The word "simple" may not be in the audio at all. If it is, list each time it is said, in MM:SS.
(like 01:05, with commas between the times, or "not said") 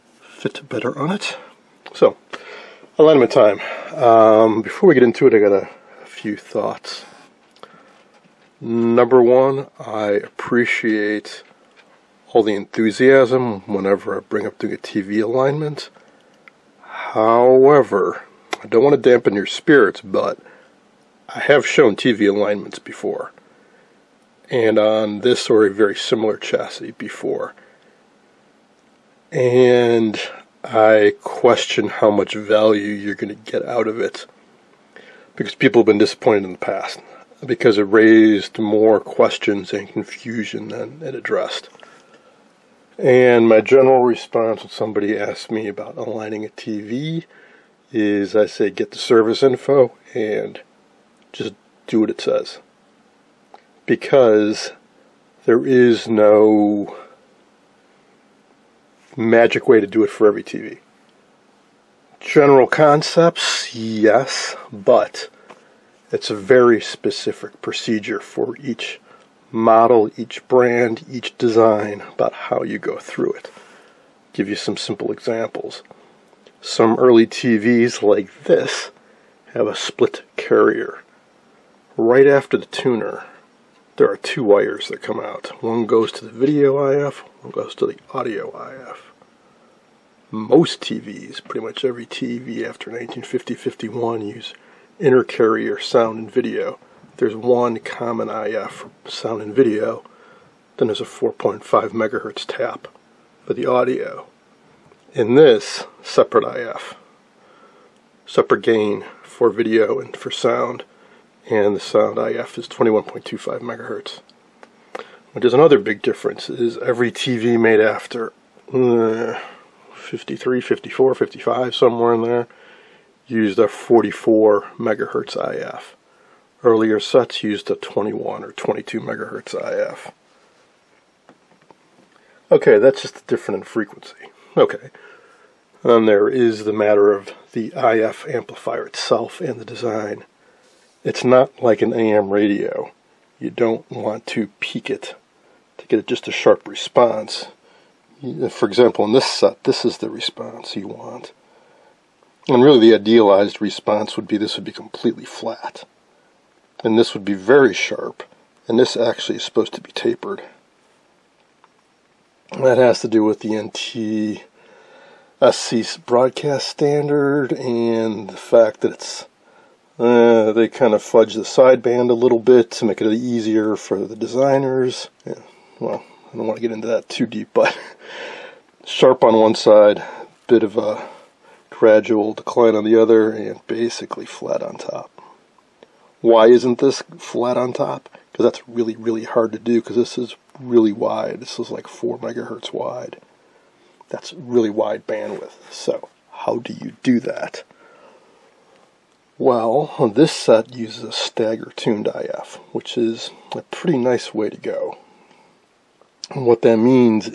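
01:14.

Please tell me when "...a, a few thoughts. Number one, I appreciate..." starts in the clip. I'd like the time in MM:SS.
00:05.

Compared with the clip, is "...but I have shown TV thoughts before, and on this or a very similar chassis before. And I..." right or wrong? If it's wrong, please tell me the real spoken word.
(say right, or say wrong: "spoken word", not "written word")
wrong: "alignments", not "thoughts".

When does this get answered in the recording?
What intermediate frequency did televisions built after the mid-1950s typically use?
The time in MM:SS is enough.
02:03.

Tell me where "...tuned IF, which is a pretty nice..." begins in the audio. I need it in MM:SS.
03:21.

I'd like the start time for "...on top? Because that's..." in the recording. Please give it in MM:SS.
03:07.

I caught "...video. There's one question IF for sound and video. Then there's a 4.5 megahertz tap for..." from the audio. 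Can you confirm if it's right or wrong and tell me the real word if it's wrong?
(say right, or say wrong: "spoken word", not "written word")
wrong: "common", not "question".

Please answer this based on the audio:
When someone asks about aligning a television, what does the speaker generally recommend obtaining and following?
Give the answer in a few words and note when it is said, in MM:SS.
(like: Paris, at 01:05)
The service info, at 00:48.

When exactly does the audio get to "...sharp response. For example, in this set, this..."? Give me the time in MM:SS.
02:26.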